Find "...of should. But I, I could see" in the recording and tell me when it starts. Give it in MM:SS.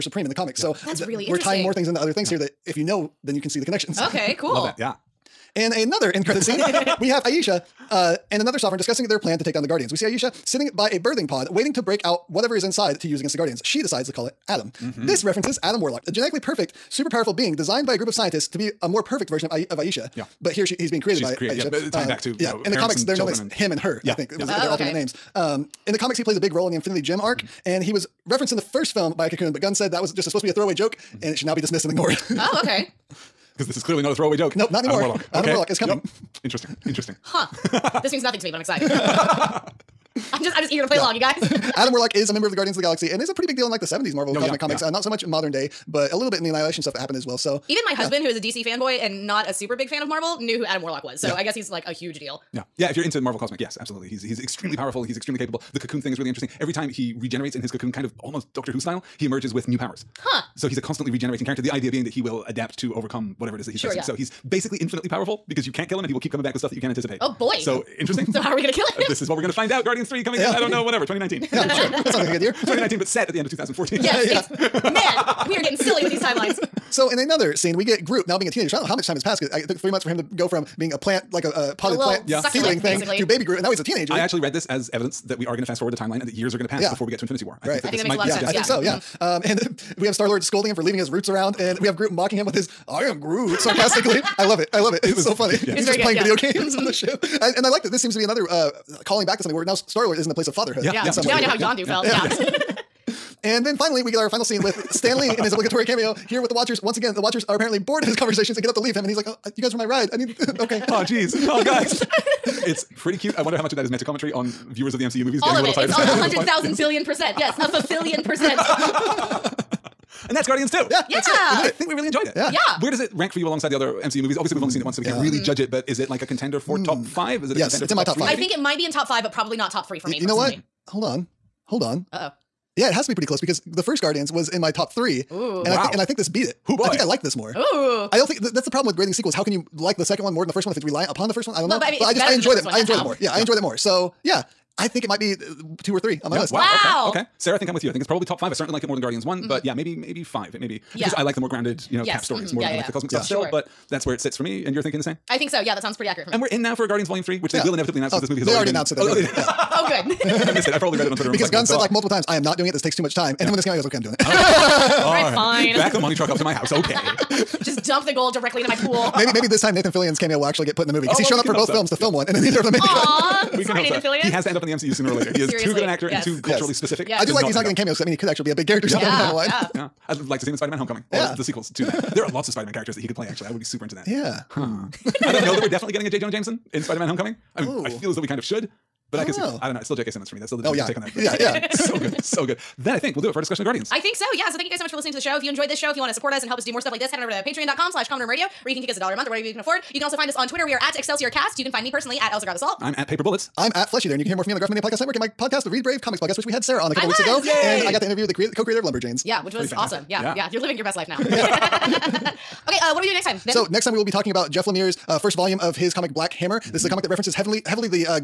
03:08.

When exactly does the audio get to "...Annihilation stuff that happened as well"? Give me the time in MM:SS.
00:46.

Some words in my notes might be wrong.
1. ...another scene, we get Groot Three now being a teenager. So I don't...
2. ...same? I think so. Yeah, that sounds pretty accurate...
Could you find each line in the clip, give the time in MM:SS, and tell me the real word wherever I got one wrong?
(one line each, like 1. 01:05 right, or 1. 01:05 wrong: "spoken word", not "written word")
1. 01:17 wrong: "Groot", not "Three"
2. 02:35 right.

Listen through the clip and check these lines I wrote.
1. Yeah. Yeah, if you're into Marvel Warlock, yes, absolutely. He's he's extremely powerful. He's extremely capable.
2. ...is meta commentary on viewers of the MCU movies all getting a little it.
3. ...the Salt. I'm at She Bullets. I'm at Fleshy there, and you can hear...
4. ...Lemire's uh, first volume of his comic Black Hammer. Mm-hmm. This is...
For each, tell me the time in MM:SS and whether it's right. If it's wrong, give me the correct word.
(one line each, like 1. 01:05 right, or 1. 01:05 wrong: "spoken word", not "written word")
1. 00:52 wrong: "Cosmic", not "Warlock"
2. 01:53 right
3. 03:22 wrong: "Paper", not "She"
4. 03:34 right.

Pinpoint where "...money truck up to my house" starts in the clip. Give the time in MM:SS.
02:45.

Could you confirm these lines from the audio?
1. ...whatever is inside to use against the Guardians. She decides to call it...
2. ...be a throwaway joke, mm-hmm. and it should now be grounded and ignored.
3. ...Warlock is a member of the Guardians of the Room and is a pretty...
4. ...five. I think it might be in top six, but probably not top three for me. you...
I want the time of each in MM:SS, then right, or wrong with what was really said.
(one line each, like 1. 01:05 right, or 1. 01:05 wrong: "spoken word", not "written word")
1. 00:12 right
2. 00:30 wrong: "dismissed", not "grounded"
3. 00:41 wrong: "Galaxy", not "Room"
4. 02:08 wrong: "five", not "six".